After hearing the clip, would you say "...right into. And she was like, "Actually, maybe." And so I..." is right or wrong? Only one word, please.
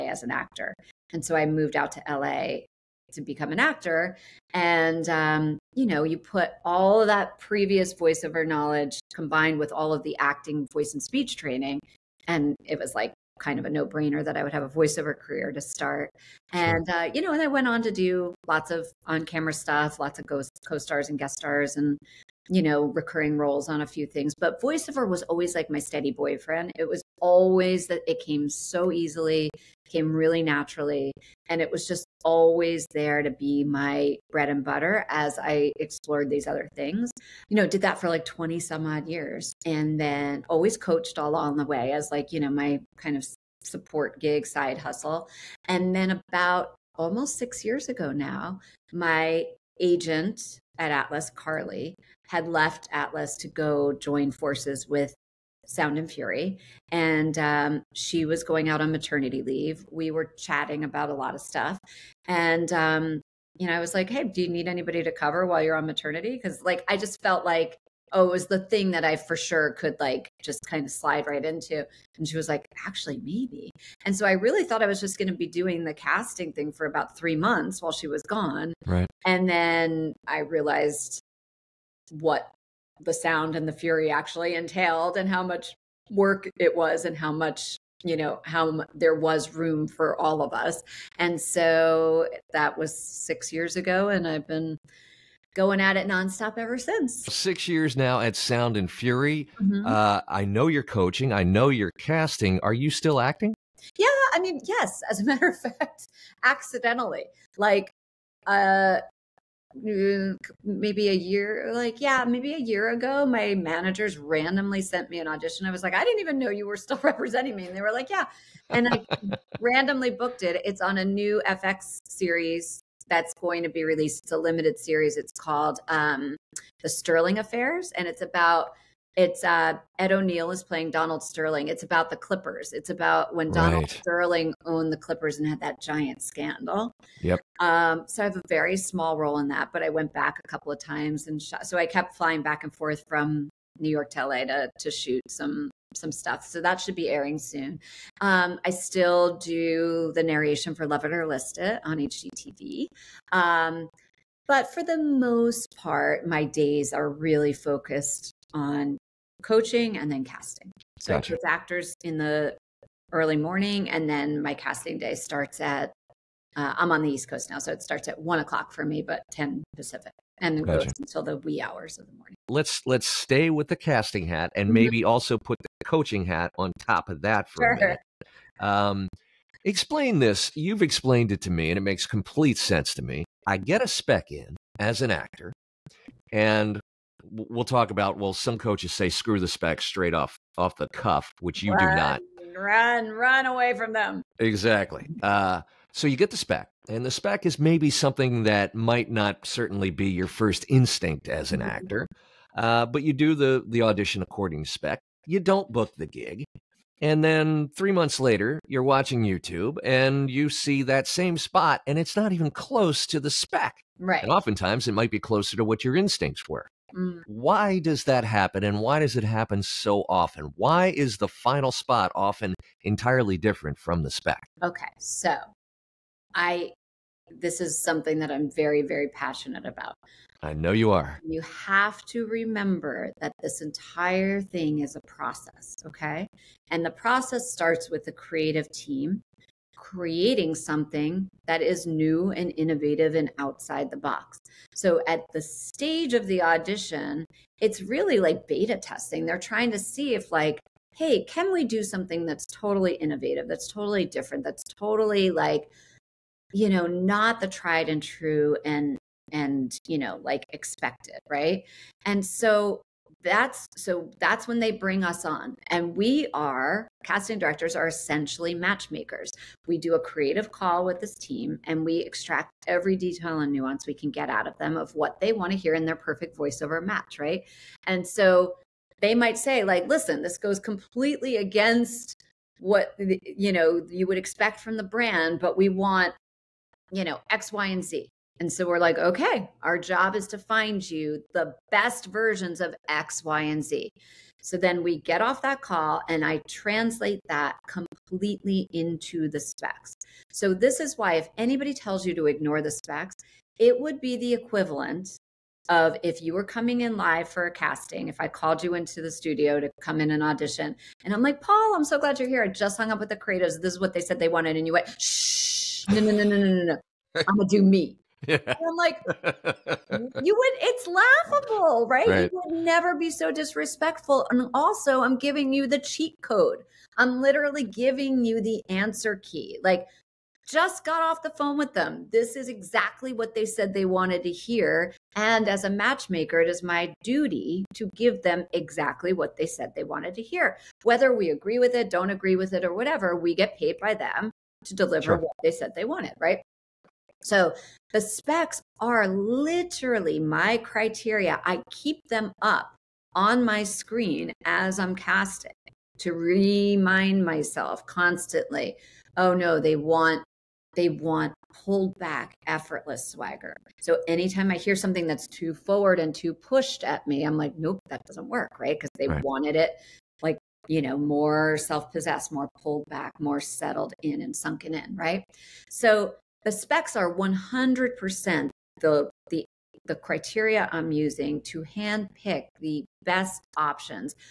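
right.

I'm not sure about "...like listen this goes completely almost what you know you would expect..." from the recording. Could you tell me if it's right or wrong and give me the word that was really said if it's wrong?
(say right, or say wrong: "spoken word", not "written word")
wrong: "against", not "almost".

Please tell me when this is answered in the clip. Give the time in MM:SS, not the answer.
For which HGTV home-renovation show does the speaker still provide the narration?
02:30.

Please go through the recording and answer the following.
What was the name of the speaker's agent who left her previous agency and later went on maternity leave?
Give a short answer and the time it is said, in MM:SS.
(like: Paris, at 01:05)
Carly, at 00:51.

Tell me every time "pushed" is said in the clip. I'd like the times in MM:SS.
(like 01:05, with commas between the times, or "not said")
06:06.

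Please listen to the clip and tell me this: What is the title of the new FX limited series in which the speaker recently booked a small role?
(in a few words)
The Sterling Affairs.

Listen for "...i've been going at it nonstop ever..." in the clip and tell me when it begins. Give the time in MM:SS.
01:34.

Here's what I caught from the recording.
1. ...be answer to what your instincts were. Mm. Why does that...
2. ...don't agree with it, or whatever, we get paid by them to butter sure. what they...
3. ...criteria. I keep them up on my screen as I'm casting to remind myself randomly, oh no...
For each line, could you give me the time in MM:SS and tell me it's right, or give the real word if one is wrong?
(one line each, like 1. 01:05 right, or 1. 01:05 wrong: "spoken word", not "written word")
1. 03:35 wrong: "closer", not "answer"
2. 05:41 wrong: "deliver", not "butter"
3. 05:50 wrong: "constantly", not "randomly".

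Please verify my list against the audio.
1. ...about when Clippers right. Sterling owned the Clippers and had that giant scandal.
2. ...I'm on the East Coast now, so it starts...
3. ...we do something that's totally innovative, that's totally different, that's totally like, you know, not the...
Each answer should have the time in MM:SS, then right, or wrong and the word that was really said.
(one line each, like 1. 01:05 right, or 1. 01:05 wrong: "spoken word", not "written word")
1. 02:12 wrong: "Donald", not "Clippers"
2. 02:46 right
3. 04:11 right.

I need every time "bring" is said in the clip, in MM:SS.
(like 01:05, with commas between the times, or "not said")
04:24.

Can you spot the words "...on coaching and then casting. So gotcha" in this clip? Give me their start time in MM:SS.
02:38.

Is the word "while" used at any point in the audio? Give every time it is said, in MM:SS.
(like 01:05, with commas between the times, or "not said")
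01:05, 01:17.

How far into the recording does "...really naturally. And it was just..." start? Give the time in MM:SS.
00:30.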